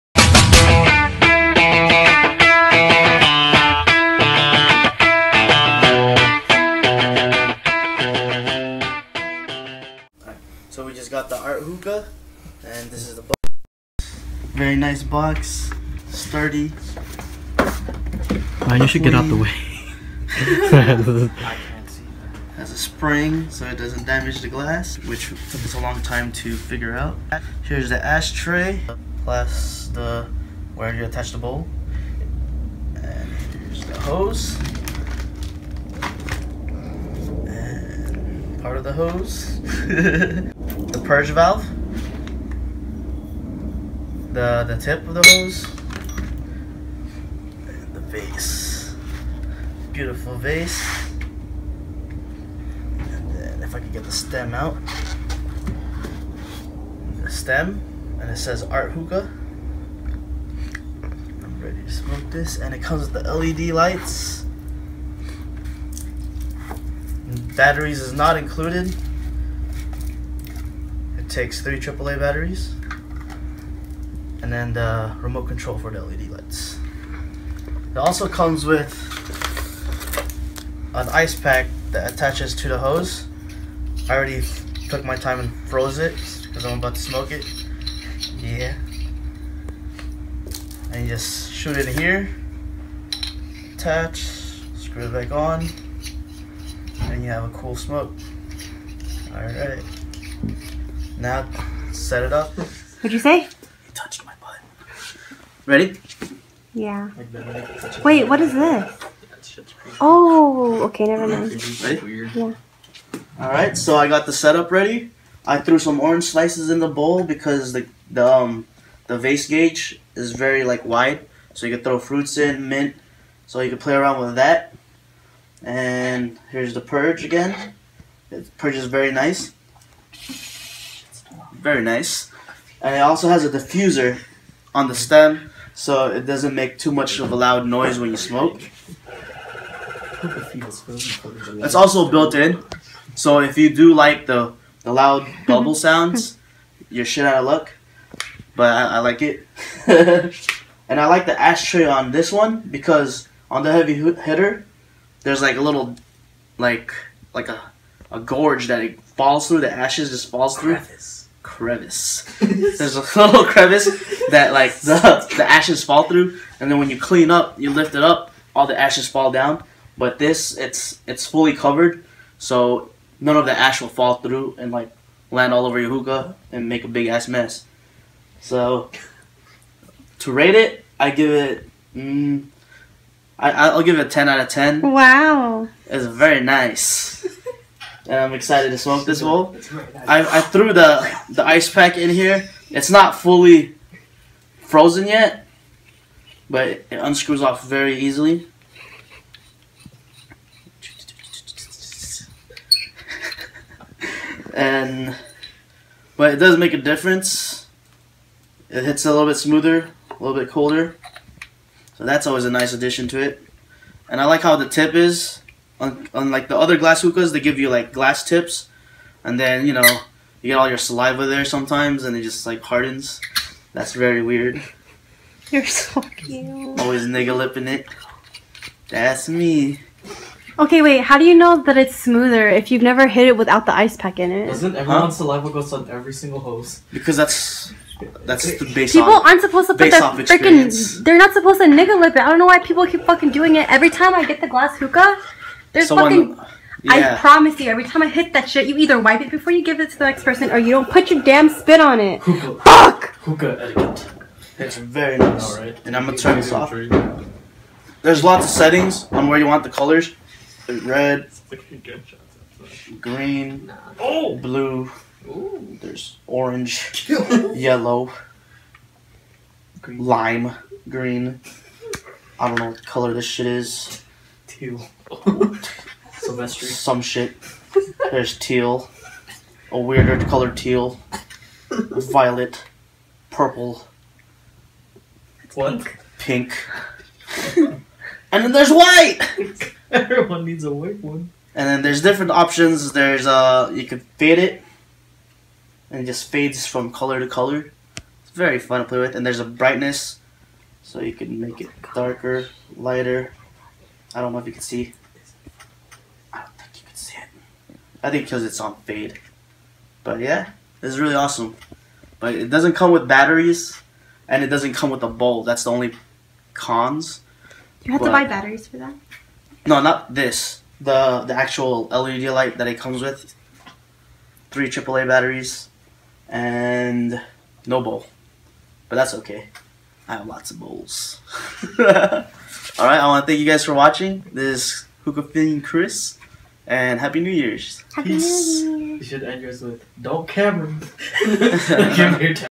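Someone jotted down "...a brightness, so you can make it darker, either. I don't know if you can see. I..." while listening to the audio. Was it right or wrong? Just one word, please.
wrong.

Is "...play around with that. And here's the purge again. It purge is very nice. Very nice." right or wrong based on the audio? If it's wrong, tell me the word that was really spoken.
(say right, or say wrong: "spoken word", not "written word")
right.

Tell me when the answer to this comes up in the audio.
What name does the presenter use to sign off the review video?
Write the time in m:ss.
5:35.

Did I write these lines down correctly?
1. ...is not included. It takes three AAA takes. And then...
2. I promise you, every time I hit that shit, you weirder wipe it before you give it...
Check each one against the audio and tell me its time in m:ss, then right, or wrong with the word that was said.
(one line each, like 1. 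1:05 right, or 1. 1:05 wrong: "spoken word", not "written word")
1. 1:08 wrong: "batteries", not "takes"
2. 4:07 wrong: "either", not "weirder".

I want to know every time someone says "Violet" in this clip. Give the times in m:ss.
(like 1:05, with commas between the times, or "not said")
4:41.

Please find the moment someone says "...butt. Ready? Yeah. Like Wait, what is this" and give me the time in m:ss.
1:44.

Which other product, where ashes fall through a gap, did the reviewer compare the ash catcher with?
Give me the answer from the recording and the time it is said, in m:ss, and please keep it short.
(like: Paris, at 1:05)
The Heavy Hitter, at 2:33.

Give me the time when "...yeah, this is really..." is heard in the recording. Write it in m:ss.
5:10.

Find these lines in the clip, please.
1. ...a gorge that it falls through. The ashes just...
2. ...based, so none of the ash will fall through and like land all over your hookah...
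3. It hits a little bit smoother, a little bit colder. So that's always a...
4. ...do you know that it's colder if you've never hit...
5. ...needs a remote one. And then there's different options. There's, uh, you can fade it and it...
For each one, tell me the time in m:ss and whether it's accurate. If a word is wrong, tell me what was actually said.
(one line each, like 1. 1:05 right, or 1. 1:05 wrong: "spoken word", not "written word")
1. 2:38 right
2. 2:51 wrong: "covered", not "based"
3. 3:28 right
4. 3:51 wrong: "smoother", not "colder"
5. 4:50 wrong: "white", not "remote".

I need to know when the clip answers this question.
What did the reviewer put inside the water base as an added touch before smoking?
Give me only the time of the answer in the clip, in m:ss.
1:55.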